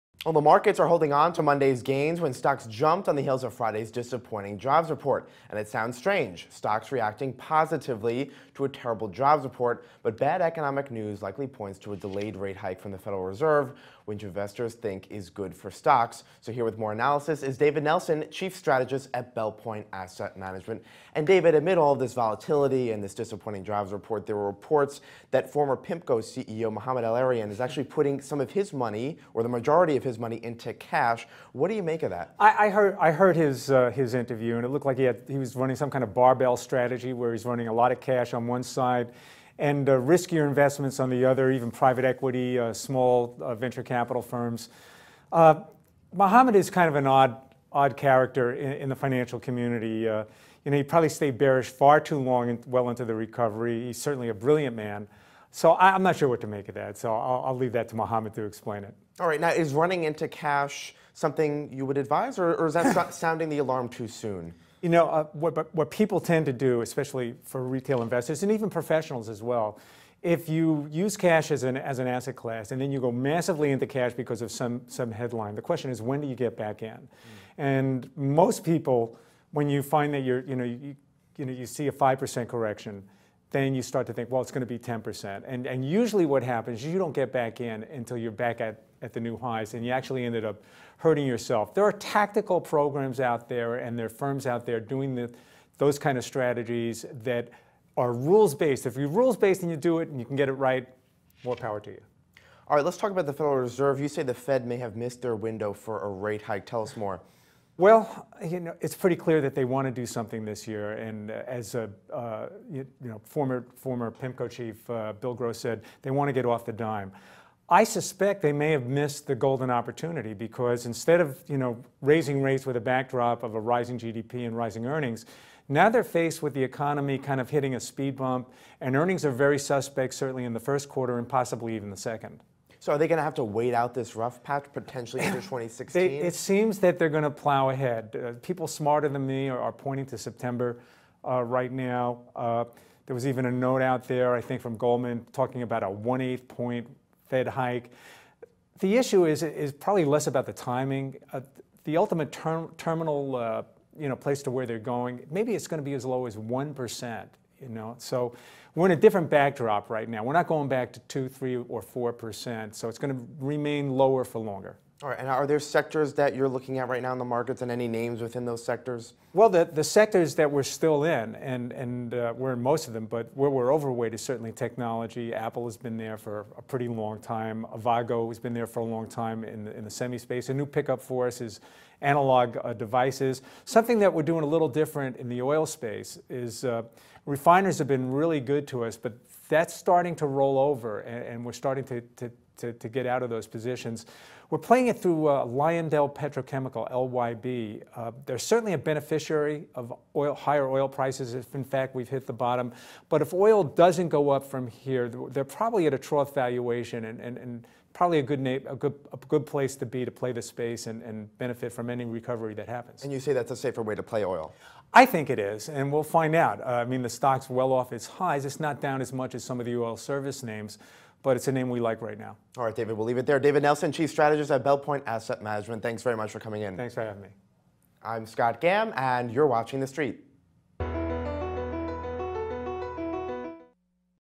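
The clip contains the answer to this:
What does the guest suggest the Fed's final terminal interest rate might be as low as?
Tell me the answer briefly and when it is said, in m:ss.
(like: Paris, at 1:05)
1%, at 2:36.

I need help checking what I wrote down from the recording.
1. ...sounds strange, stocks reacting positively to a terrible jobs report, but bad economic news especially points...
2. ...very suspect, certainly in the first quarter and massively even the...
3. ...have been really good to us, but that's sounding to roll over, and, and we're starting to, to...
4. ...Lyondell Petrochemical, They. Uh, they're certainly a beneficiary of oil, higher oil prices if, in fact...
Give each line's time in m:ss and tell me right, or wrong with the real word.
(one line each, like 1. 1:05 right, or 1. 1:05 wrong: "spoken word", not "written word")
1. 0:05 wrong: "likely", not "especially"
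2. 2:09 wrong: "possibly", not "massively"
3. 3:07 wrong: "starting", not "sounding"
4. 3:15 wrong: "LYB", not "They".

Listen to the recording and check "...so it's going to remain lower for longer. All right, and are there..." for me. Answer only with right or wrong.
right.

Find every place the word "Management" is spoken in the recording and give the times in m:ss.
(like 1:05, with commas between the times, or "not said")
0:20, 3:45.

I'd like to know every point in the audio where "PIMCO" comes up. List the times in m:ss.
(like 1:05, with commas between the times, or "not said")
0:25, 1:54.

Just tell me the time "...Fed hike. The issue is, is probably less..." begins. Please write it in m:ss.
2:27.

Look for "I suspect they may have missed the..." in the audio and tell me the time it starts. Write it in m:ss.
1:57.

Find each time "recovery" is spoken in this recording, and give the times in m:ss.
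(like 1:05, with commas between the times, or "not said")
0:53, 3:32.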